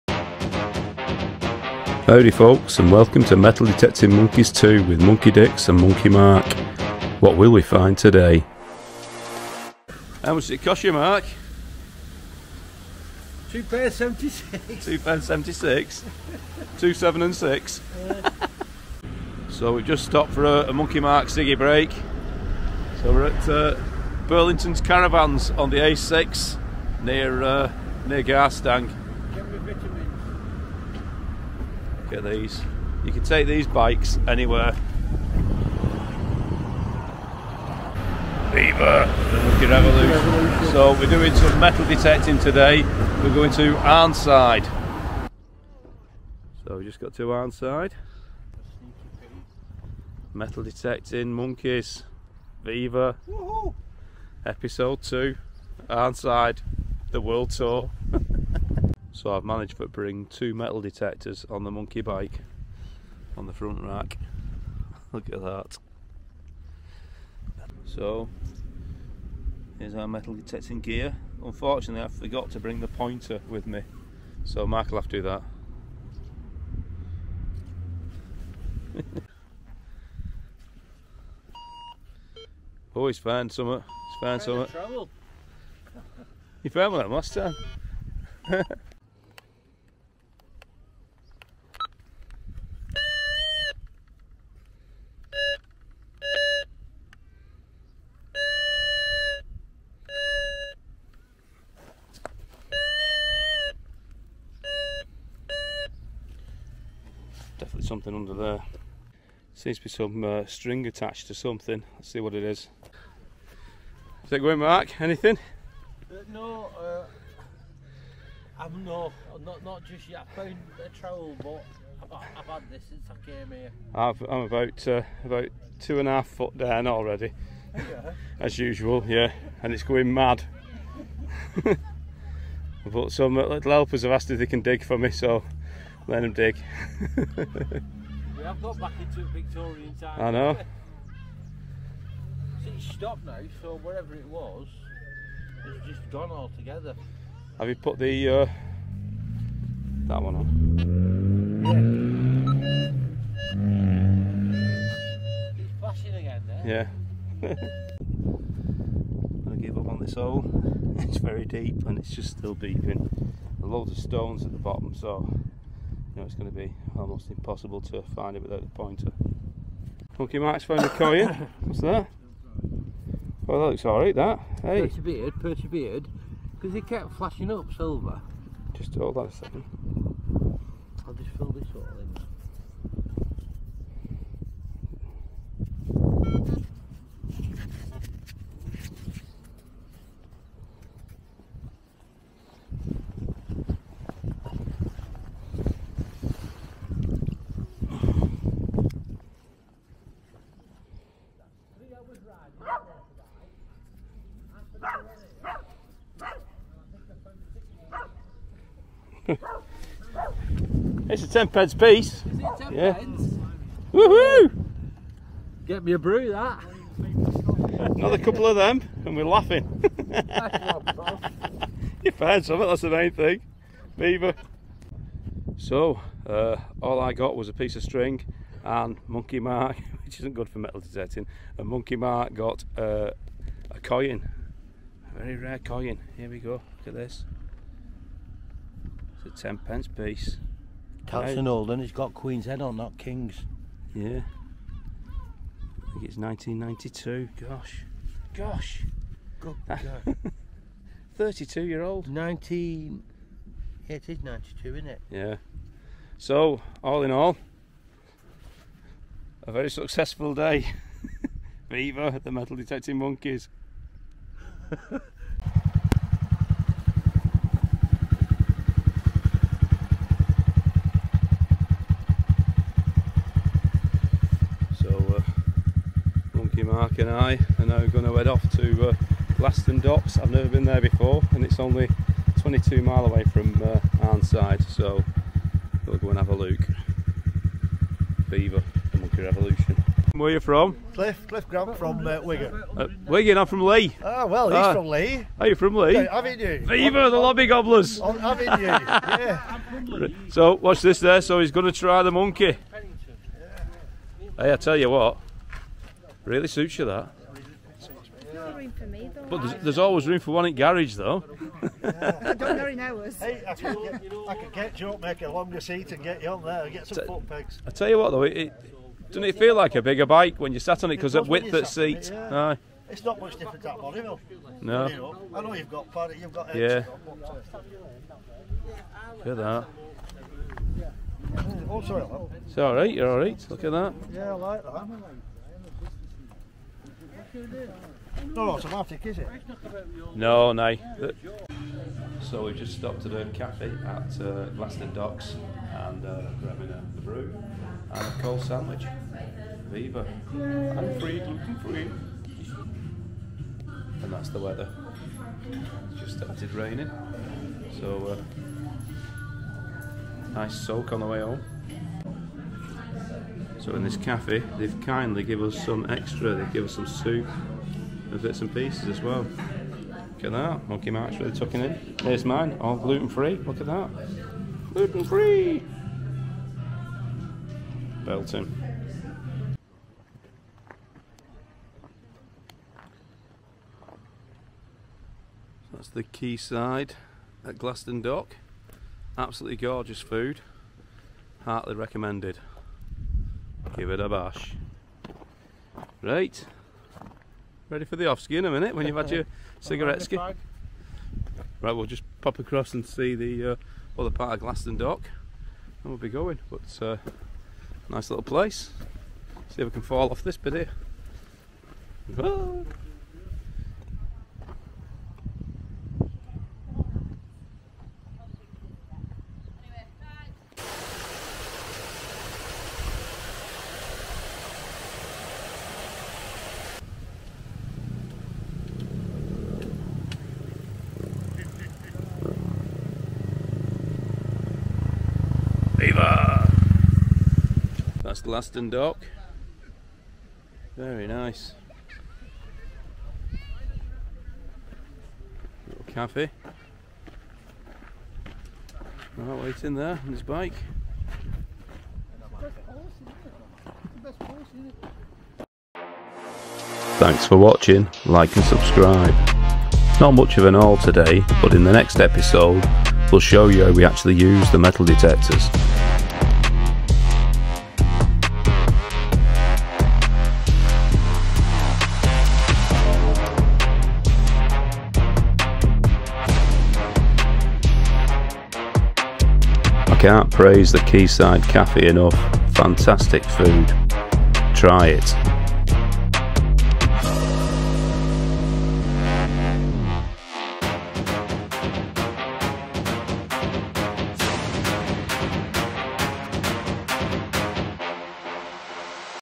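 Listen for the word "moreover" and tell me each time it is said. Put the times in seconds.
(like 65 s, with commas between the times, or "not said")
not said.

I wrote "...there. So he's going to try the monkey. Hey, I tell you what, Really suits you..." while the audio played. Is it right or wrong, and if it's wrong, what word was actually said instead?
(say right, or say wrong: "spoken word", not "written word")
right.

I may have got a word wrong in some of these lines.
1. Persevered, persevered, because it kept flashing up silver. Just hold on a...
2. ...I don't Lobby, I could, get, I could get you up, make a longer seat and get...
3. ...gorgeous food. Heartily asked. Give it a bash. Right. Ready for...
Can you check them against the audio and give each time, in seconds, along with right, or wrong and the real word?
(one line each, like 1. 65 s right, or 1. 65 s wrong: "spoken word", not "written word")
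1. 174 s right
2. 311 s wrong: "Hey", not "Lobby"
3. 389 s wrong: "recommended", not "asked".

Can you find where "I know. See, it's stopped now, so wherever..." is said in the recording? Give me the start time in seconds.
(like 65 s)
140 s.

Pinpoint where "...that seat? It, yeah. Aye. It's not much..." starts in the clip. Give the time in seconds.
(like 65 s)
321 s.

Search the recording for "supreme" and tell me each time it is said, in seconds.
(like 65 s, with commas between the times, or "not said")
not said.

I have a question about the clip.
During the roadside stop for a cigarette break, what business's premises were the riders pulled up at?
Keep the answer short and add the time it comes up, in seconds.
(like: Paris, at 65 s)
Burlington's Caravans, at 24 s.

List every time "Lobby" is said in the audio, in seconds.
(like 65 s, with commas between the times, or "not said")
297 s.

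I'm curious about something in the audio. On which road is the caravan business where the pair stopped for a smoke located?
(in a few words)
A6.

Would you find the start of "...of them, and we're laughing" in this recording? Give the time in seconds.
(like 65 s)
218 s.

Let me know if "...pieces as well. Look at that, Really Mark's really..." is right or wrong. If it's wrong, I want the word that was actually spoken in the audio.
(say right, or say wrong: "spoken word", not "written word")
wrong: "Monkey", not "Really".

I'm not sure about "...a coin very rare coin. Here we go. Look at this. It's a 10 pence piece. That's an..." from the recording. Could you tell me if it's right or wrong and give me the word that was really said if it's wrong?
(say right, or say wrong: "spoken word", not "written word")
right.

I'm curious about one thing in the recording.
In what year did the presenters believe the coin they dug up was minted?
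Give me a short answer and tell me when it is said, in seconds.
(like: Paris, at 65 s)
1992, at 246 s.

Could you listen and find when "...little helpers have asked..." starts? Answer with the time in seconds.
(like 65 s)
133 s.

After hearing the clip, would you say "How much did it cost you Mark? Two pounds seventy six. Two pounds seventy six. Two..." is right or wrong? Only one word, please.
right.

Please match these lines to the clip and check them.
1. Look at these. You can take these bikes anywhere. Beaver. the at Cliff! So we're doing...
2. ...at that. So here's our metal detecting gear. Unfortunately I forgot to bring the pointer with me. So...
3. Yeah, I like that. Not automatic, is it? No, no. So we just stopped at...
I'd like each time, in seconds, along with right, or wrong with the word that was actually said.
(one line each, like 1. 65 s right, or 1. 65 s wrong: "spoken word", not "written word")
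1. 32 s wrong: "Revolution", not "Cliff"
2. 65 s right
3. 334 s right.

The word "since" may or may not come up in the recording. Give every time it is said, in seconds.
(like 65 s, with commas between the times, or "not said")
122 s.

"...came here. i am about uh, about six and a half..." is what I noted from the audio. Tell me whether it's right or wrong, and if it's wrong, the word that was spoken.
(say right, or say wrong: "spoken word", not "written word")
wrong: "two", not "six".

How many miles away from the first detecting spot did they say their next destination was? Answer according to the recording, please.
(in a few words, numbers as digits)
22.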